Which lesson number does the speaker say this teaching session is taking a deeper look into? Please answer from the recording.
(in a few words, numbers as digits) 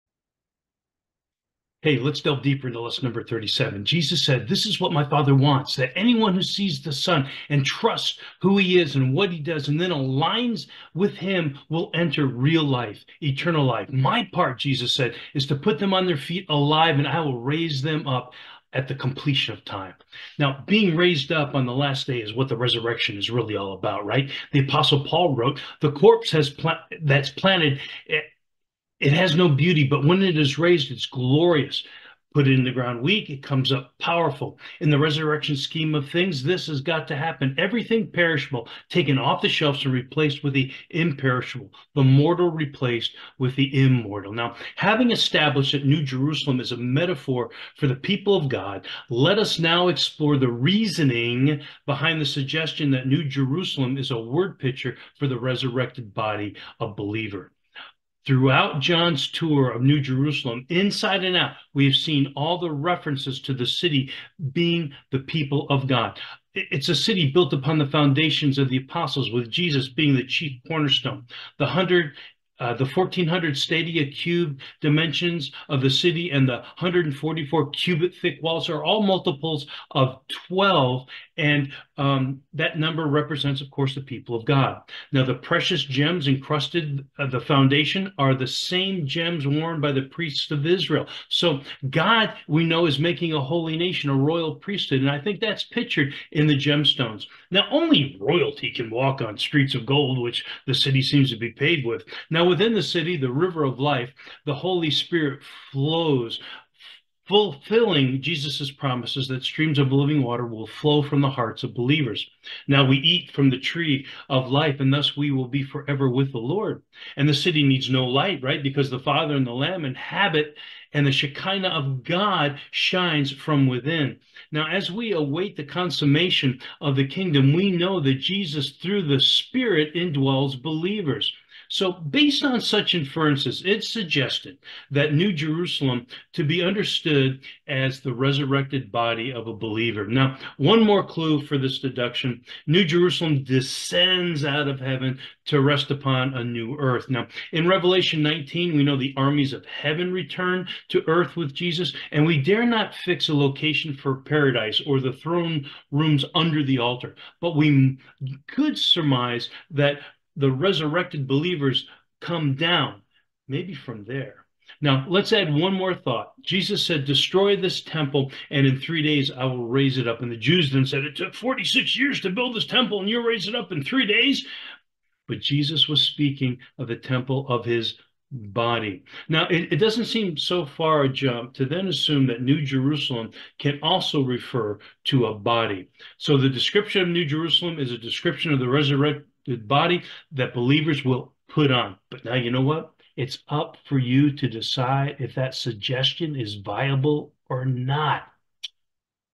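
37.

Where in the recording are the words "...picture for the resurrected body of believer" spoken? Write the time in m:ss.
0:54.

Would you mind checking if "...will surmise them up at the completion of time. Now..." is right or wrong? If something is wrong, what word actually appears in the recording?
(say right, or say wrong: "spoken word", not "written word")
wrong: "raise", not "surmise".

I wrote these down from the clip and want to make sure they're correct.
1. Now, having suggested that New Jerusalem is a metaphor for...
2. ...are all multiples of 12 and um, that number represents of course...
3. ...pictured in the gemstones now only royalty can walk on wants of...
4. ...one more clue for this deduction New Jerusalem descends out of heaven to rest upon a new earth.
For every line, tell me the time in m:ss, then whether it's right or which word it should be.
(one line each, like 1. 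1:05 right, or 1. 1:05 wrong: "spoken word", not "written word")
1. 0:44 wrong: "established", not "suggested"
2. 1:18 right
3. 1:35 wrong: "streets", not "wants"
4. 2:20 right.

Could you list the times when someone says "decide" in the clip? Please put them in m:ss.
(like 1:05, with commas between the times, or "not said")
3:14.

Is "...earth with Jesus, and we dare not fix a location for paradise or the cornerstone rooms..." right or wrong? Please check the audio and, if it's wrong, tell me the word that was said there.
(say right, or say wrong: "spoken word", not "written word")
wrong: "throne", not "cornerstone".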